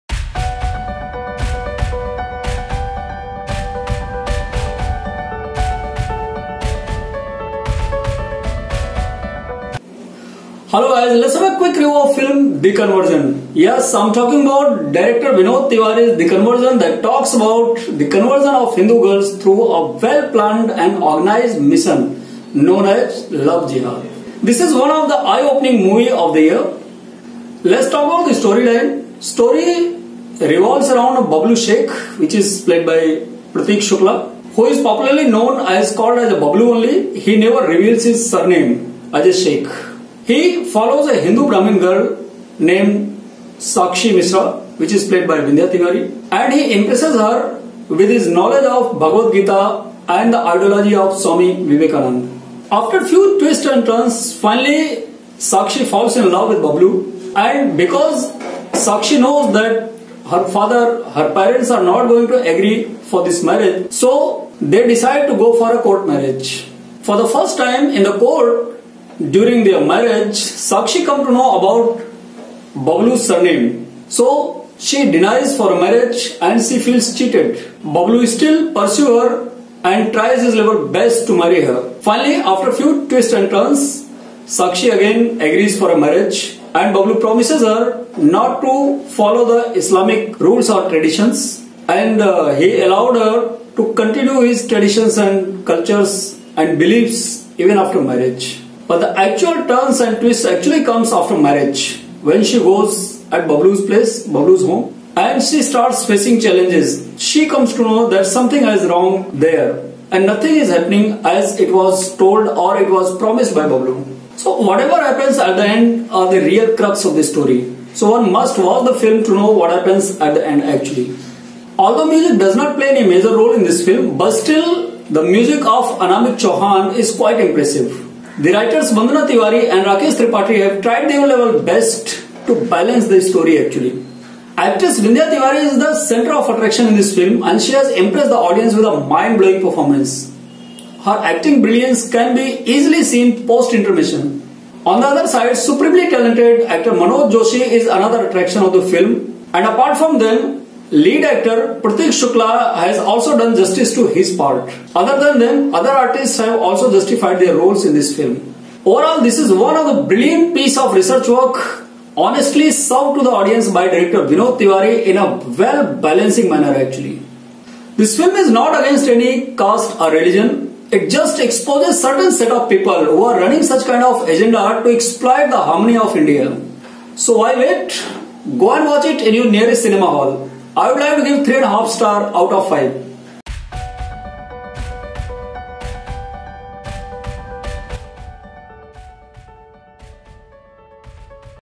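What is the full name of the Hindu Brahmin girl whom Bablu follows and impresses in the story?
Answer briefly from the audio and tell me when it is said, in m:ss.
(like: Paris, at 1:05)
Sakshi Mishra, at 0:43.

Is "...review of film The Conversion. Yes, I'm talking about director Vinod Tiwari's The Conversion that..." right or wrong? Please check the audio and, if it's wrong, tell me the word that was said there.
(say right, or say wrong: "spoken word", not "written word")
right.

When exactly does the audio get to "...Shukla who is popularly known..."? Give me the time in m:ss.
0:33.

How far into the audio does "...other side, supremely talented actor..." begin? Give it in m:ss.
2:25.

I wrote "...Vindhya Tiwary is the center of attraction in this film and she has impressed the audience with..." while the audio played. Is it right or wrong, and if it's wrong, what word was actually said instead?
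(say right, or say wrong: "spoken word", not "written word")
right.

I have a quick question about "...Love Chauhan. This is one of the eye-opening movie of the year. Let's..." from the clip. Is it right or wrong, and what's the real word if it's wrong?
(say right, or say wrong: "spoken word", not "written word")
wrong: "Jihad", not "Chauhan".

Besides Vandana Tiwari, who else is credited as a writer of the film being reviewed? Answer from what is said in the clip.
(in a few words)
Rakesh Tripathi.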